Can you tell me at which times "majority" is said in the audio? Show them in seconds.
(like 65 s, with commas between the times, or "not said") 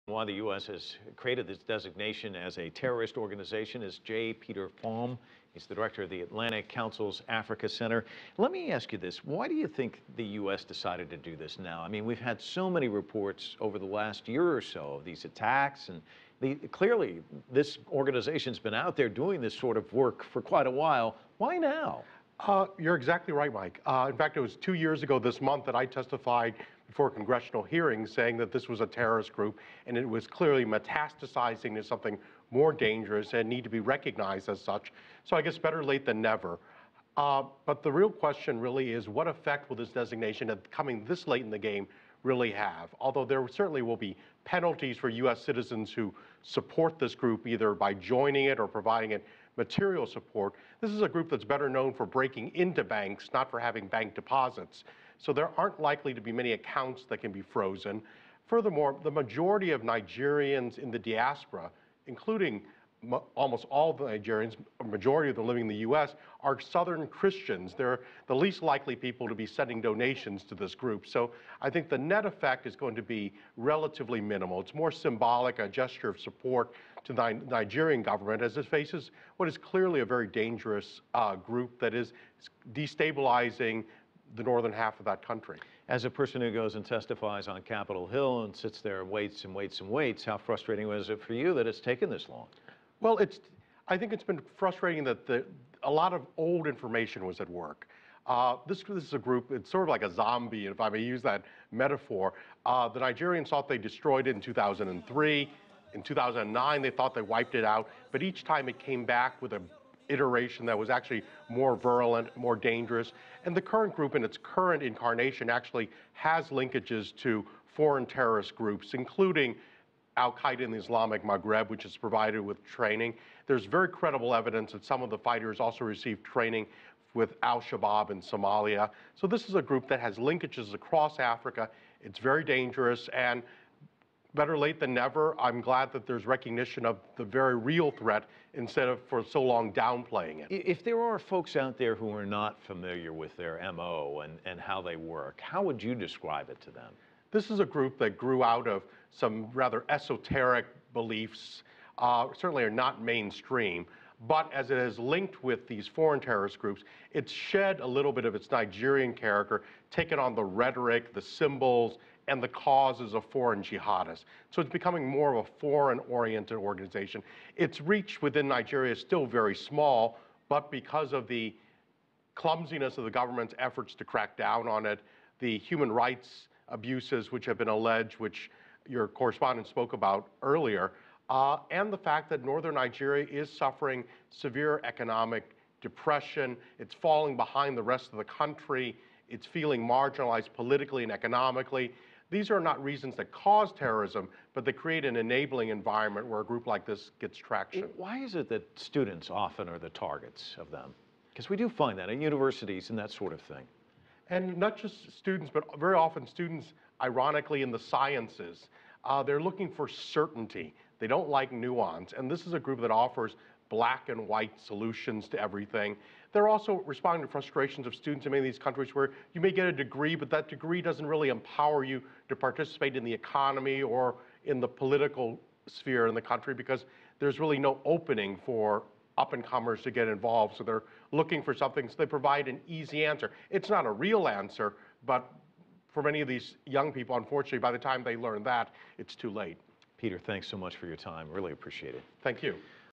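59 s, 64 s.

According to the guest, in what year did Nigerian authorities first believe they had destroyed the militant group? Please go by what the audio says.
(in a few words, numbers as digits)
2003.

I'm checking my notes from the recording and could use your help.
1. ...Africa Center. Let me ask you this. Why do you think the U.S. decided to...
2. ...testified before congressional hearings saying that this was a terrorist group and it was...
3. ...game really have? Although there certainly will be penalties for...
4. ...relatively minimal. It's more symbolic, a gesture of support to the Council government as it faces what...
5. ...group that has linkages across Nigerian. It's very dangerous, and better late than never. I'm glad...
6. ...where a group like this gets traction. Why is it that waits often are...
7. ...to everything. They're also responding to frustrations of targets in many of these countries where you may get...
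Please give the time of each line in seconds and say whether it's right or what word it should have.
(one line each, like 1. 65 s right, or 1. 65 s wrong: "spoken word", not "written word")
1. 7 s right
2. 25 s right
3. 41 s right
4. 73 s wrong: "Nigerian", not "Council"
5. 129 s wrong: "Africa", not "Nigerian"
6. 196 s wrong: "students", not "waits"
7. 215 s wrong: "students", not "targets".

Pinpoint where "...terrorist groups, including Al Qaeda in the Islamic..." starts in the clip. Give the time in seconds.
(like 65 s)
118 s.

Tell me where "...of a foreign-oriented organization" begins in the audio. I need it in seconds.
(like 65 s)
165 s.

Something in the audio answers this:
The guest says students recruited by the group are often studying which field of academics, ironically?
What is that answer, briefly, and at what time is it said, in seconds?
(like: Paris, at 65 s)
The sciences, at 207 s.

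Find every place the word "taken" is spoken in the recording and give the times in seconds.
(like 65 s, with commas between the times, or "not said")
91 s, 159 s.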